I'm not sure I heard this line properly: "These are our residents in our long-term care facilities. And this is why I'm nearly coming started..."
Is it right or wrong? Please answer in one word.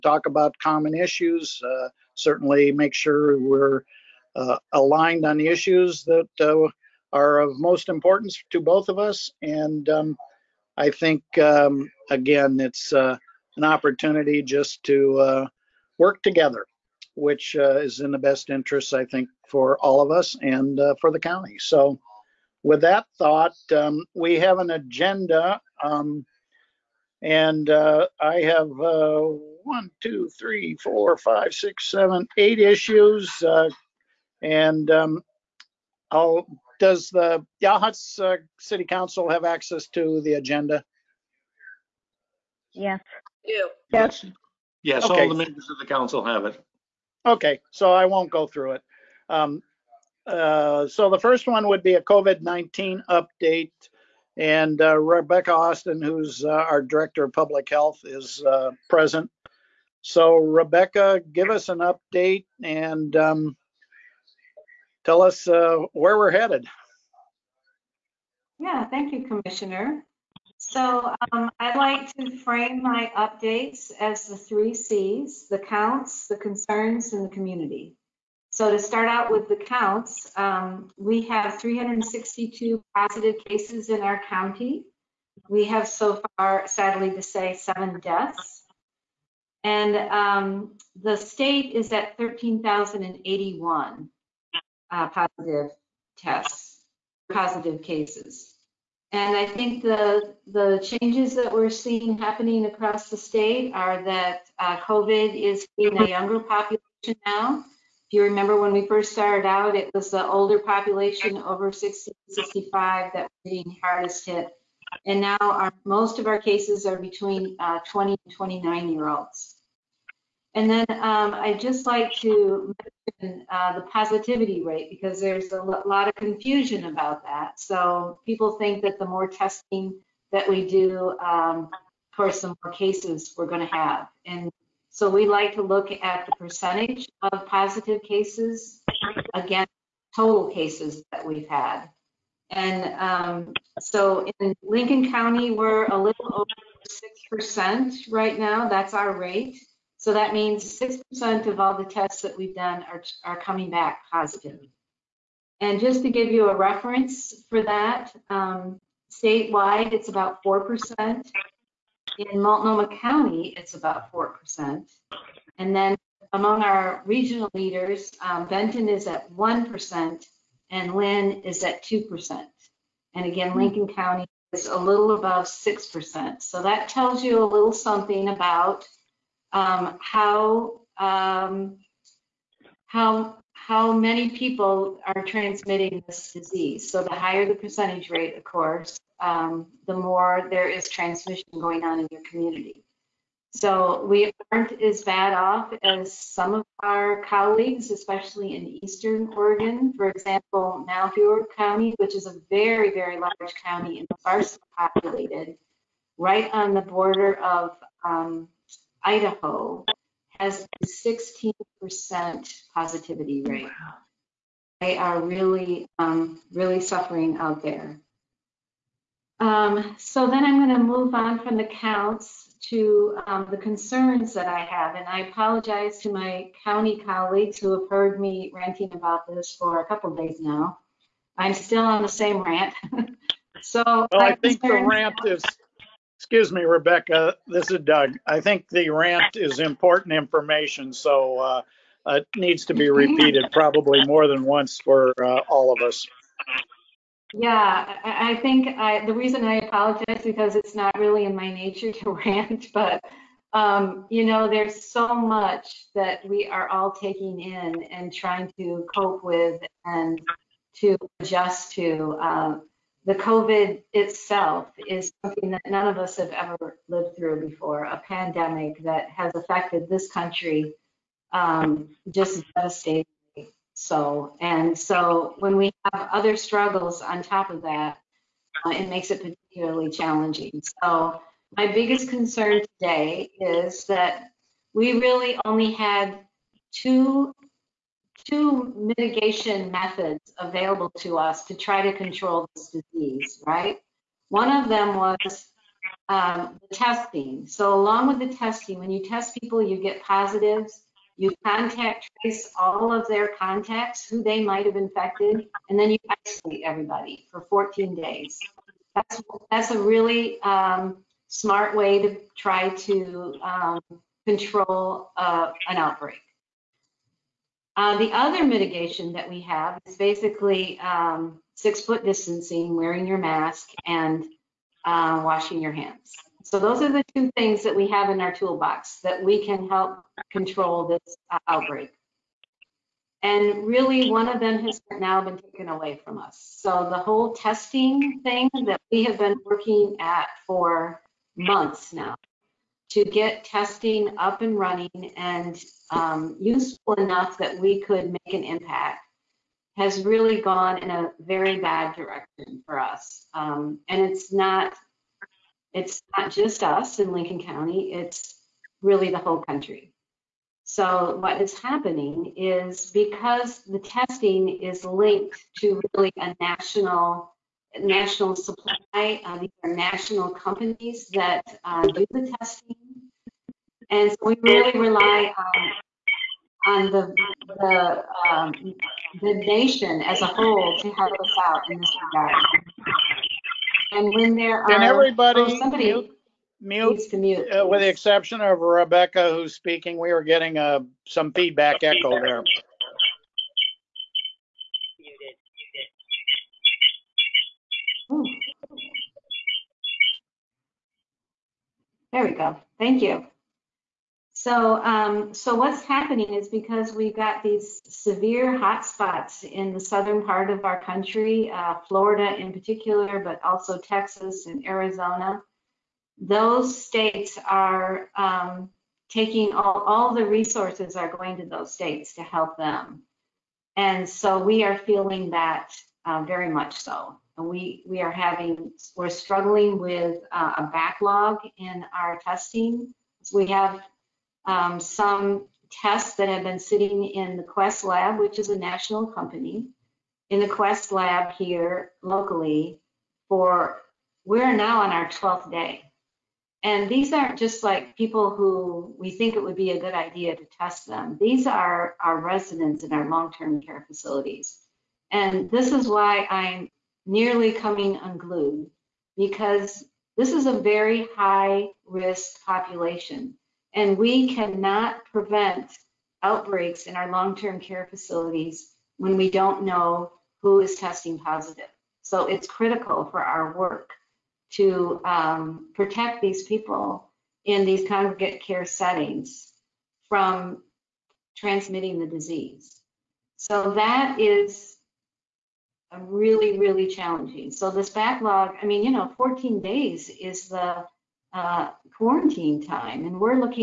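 wrong.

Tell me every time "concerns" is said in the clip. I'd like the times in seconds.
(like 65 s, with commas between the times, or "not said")
76 s, 223 s, 282 s.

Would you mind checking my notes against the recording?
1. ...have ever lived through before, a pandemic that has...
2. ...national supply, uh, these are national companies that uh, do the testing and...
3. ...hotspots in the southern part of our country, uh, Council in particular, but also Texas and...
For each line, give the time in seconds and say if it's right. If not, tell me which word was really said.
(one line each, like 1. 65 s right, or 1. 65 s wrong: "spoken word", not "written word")
1. 266 s right
2. 367 s right
3. 408 s wrong: "Florida", not "Council".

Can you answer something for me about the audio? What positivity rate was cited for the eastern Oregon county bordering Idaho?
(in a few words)
16%.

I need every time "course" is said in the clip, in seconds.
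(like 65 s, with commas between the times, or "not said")
132 s, 188 s.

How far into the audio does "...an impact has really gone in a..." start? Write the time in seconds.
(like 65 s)
348 s.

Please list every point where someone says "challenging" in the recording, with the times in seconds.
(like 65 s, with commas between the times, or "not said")
279 s, 486 s.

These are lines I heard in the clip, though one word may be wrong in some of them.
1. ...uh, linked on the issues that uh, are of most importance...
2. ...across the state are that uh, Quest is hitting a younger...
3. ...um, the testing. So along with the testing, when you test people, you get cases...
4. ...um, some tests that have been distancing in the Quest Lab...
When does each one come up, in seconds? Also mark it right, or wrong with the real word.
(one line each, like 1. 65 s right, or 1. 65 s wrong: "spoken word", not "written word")
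1. 4 s wrong: "aligned", not "linked"
2. 102 s wrong: "COVID", not "Quest"
3. 296 s wrong: "positives", not "cases"
4. 434 s wrong: "sitting", not "distancing".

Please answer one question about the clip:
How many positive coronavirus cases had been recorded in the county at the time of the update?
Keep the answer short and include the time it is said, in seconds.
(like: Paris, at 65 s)
362, at 81 s.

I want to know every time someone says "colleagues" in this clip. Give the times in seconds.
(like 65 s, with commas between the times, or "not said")
197 s, 227 s.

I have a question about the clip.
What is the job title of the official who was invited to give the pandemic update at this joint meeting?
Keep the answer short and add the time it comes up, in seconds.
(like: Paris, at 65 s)
Director of Public Health, at 56 s.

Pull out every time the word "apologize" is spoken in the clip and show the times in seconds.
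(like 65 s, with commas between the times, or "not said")
225 s, 249 s.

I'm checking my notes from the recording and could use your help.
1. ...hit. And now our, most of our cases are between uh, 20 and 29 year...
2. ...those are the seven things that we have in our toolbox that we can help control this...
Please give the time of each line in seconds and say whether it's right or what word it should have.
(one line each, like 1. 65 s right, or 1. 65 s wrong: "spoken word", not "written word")
1. 114 s right
2. 326 s wrong: "two", not "seven".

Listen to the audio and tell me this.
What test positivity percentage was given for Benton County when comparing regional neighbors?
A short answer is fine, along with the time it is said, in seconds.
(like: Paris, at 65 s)
1%, at 169 s.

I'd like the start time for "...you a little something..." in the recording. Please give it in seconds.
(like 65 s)
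177 s.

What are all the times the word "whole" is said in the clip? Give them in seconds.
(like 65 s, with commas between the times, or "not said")
336 s, 359 s, 380 s.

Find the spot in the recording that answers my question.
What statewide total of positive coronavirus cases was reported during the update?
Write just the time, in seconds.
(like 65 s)
92 s.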